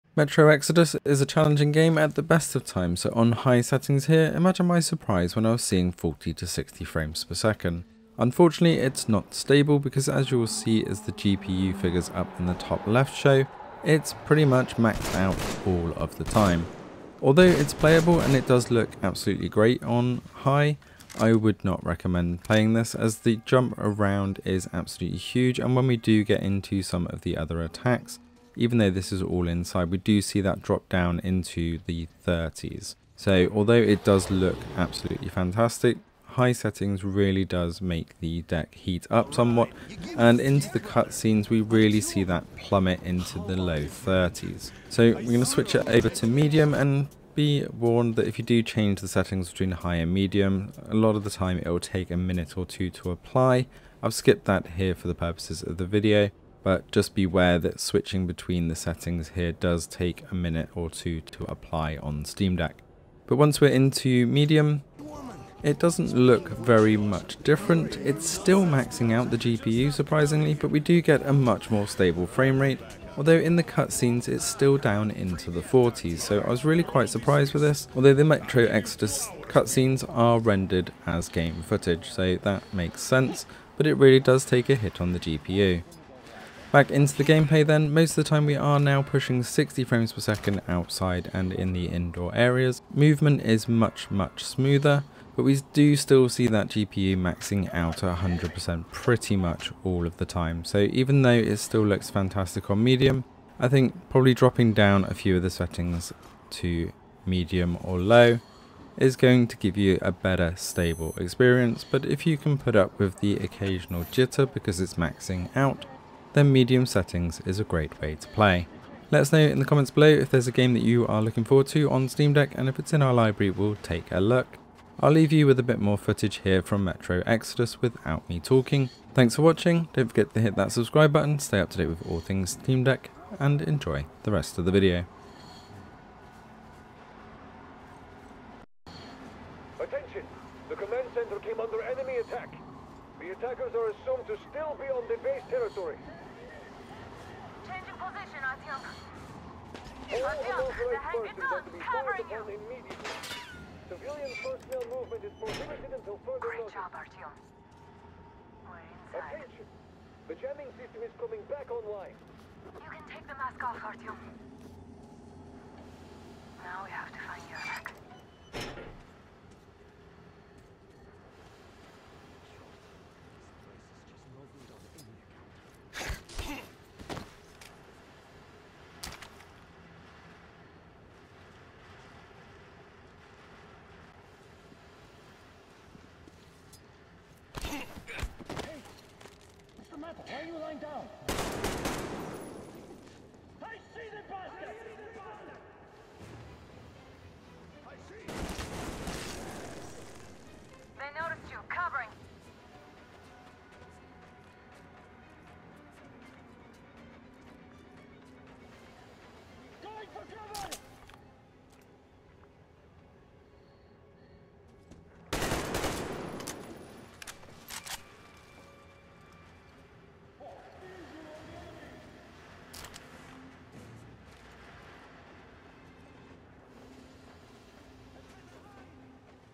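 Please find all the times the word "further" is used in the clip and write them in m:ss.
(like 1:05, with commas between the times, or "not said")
2:36.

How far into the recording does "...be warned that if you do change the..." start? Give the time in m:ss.
0:47.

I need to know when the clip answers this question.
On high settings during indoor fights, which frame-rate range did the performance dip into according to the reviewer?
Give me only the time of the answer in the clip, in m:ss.
0:31.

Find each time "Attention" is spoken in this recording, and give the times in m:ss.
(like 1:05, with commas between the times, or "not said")
2:19, 2:39.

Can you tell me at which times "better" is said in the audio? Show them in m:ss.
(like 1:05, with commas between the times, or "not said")
1:50.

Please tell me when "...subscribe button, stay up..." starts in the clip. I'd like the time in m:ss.
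2:10.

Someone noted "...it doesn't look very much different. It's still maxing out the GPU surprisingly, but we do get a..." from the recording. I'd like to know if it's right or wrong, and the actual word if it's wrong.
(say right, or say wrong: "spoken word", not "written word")
right.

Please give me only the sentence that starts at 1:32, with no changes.
Movement is much, much smoother, but we do still see that GPU maxing out at 100% pretty much all of the time.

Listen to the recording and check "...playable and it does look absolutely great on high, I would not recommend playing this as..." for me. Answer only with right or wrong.
right.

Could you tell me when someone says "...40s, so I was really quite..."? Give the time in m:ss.
1:15.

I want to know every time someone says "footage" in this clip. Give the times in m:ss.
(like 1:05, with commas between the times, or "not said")
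1:21, 2:05.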